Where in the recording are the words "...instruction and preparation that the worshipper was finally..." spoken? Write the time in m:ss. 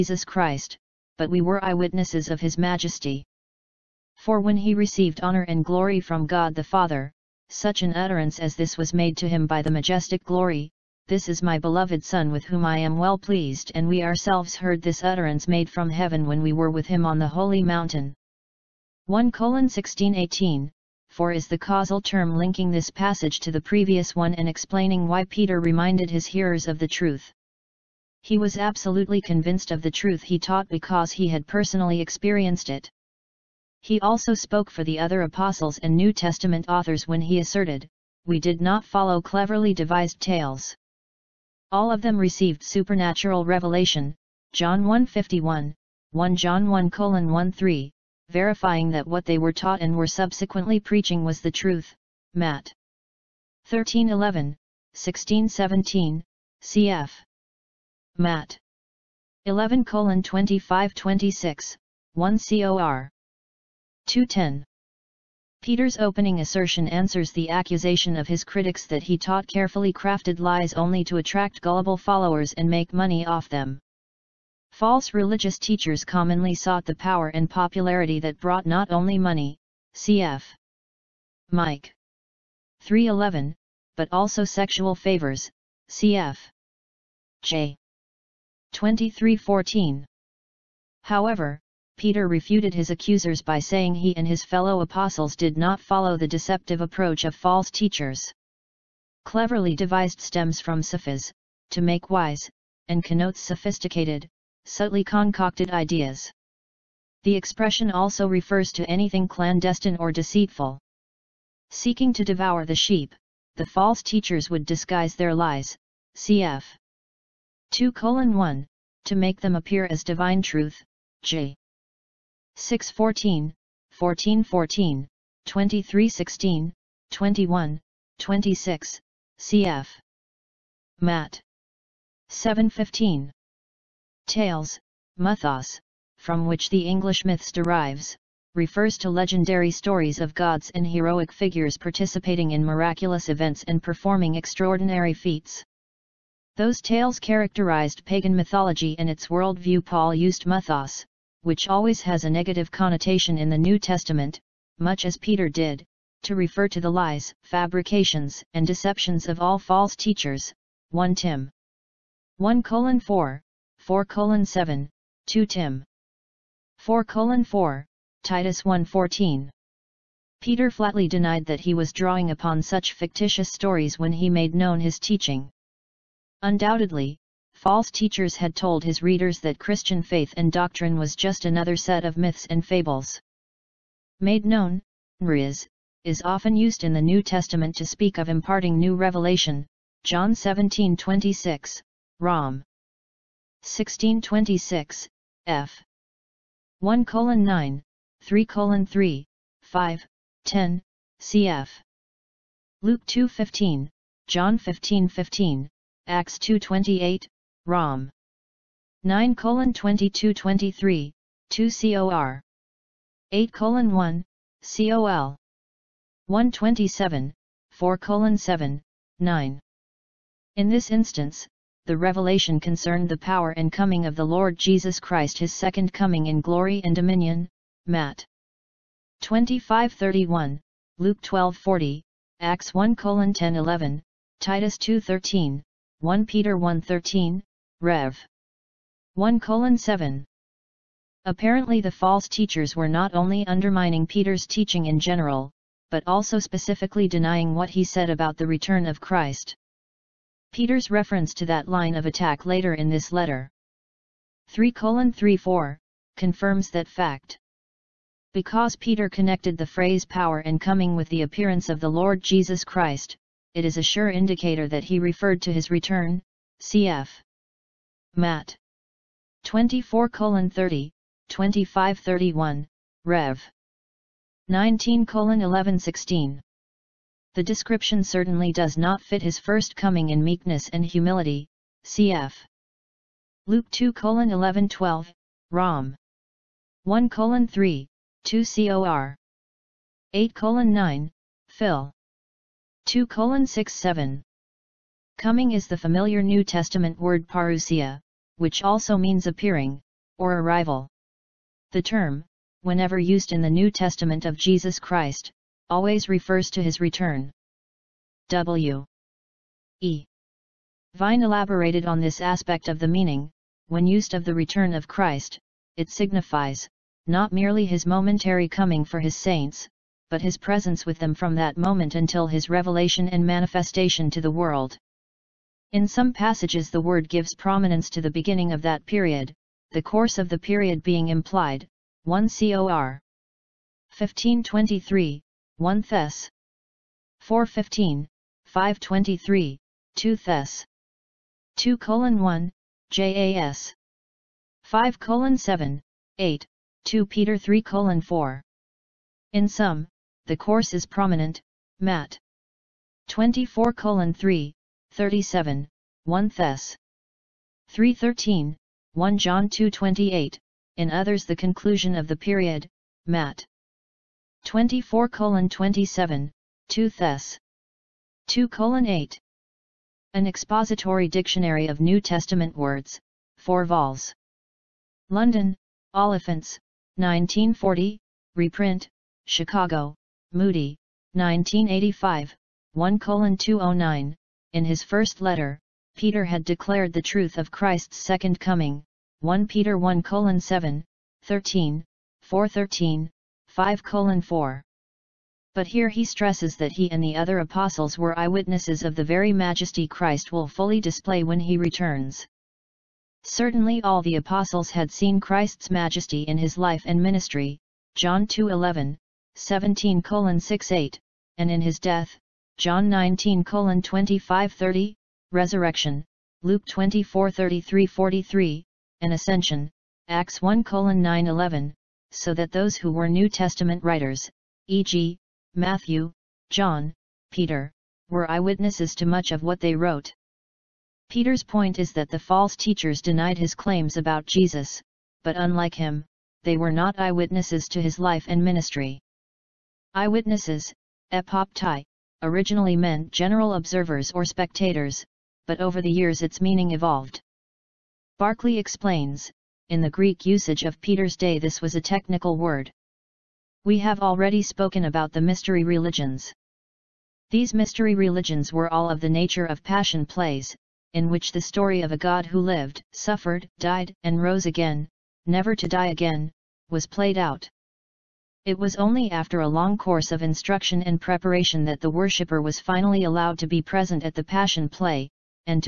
7:50.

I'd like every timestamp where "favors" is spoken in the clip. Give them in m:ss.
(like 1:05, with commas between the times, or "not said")
1:24.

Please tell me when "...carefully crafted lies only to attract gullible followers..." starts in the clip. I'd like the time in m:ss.
1:09.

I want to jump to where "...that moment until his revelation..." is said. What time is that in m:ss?
5:21.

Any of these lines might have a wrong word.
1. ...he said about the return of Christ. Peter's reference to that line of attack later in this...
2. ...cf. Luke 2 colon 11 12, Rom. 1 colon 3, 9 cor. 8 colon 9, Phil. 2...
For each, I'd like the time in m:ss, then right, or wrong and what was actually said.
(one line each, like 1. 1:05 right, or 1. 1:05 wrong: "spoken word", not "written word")
1. 4:07 right
2. 4:41 wrong: "2", not "9".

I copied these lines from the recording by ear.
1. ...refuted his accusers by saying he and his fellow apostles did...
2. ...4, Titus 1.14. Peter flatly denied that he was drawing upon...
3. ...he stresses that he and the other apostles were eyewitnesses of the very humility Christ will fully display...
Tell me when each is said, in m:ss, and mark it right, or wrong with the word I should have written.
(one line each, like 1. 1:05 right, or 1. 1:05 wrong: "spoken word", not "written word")
1. 1:32 right
2. 2:47 right
3. 6:35 wrong: "majesty", not "humility".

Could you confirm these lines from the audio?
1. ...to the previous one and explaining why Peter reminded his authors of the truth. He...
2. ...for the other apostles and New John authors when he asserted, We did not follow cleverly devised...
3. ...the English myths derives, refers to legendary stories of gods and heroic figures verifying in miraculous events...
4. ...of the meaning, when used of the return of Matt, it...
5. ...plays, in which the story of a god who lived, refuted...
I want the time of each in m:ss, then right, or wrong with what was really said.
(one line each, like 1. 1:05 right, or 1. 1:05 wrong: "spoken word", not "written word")
1. 0:23 wrong: "hearers", not "authors"
2. 0:34 wrong: "Testament", not "John"
3. 2:16 wrong: "participating", not "verifying"
4. 5:12 wrong: "Christ", not "Matt"
5. 7:40 wrong: "suffered", not "refuted".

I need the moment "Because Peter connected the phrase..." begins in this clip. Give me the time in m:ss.
4:18.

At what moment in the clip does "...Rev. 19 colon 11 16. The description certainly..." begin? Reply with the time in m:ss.
4:33.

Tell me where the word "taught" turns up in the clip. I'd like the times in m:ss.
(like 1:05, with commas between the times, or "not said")
0:30, 0:49, 1:09.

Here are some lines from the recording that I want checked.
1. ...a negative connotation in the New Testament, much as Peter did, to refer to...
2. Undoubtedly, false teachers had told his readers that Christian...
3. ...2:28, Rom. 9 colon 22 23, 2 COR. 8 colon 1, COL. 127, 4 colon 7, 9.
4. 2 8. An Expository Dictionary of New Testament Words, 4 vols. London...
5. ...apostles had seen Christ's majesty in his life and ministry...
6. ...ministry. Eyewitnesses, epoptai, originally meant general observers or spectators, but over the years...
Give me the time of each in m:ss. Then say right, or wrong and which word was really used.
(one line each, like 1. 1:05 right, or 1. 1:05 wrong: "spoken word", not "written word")
1. 2:32 right
2. 2:56 right
3. 3:26 right
4. 6:08 right
5. 6:44 right
6. 7:18 right.